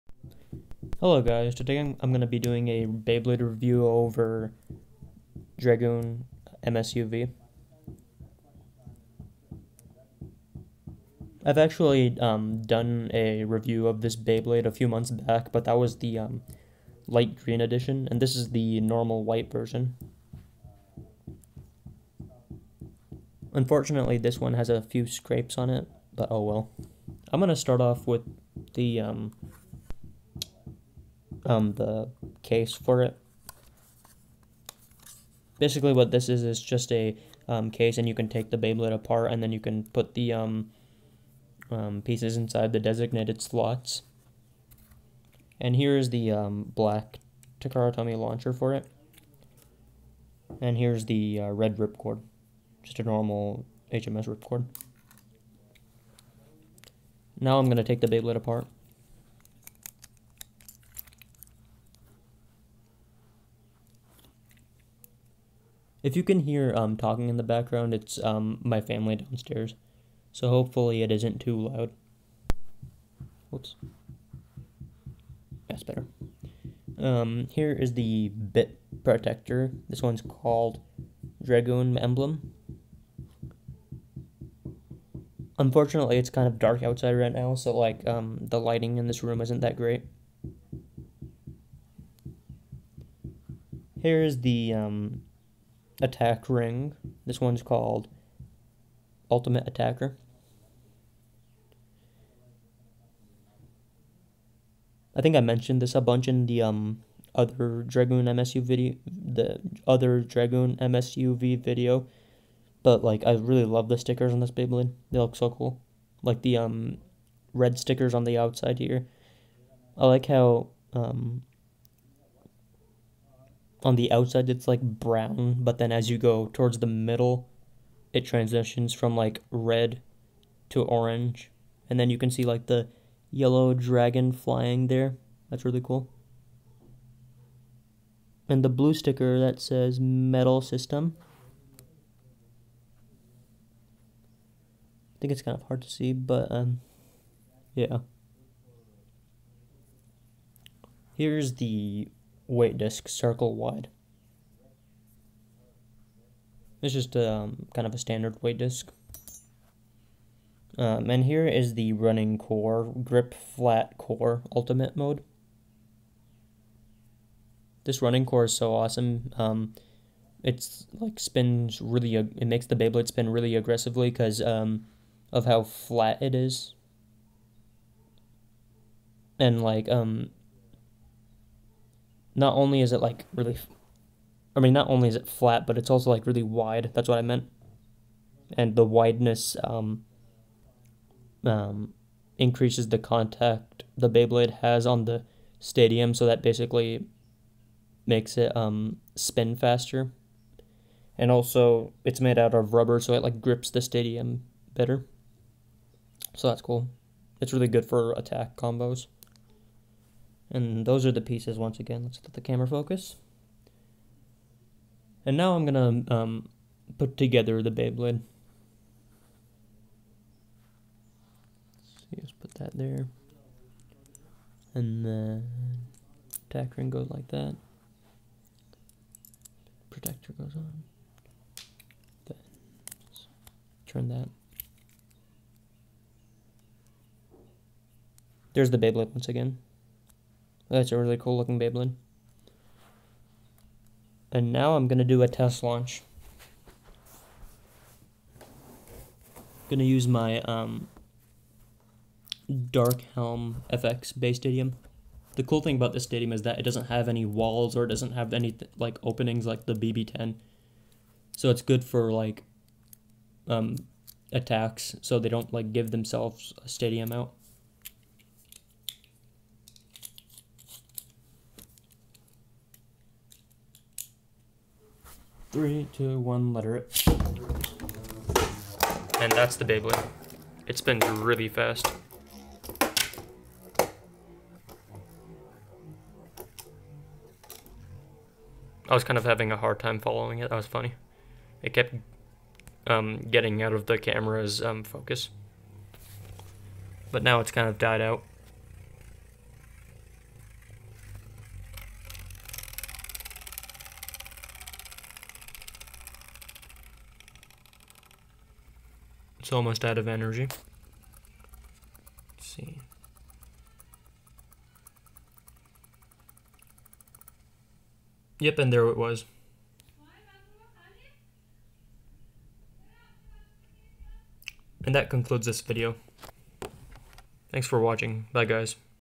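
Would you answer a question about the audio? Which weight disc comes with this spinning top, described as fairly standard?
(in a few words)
Circle Wide.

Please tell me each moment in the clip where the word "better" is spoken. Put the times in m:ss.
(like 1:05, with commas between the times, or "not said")
1:15, 3:24.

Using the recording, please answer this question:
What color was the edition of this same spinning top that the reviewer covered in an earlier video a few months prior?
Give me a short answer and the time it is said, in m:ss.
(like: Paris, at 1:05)
light green, at 0:17.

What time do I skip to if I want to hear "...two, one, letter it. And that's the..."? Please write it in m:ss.
4:35.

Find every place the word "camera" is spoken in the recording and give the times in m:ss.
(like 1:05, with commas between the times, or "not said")
3:32, 4:53.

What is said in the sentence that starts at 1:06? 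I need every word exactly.
If you can hear um, talking in the background, it's um, my family downstairs.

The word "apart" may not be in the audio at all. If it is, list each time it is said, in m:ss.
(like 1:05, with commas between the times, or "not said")
0:38, 0:58.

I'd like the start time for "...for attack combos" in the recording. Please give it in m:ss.
3:27.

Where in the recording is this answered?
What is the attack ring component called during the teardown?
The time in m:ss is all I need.
1:39.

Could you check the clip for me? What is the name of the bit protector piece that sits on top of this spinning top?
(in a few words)
Dragoon Emblem.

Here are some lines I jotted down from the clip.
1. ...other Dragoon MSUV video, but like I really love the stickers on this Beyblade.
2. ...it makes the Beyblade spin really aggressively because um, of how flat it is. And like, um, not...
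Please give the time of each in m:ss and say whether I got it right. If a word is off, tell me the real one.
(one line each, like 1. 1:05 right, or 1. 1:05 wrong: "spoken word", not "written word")
1. 1:49 right
2. 2:52 right.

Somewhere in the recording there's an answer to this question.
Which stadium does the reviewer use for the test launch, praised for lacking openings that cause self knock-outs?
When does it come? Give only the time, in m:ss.
4:12.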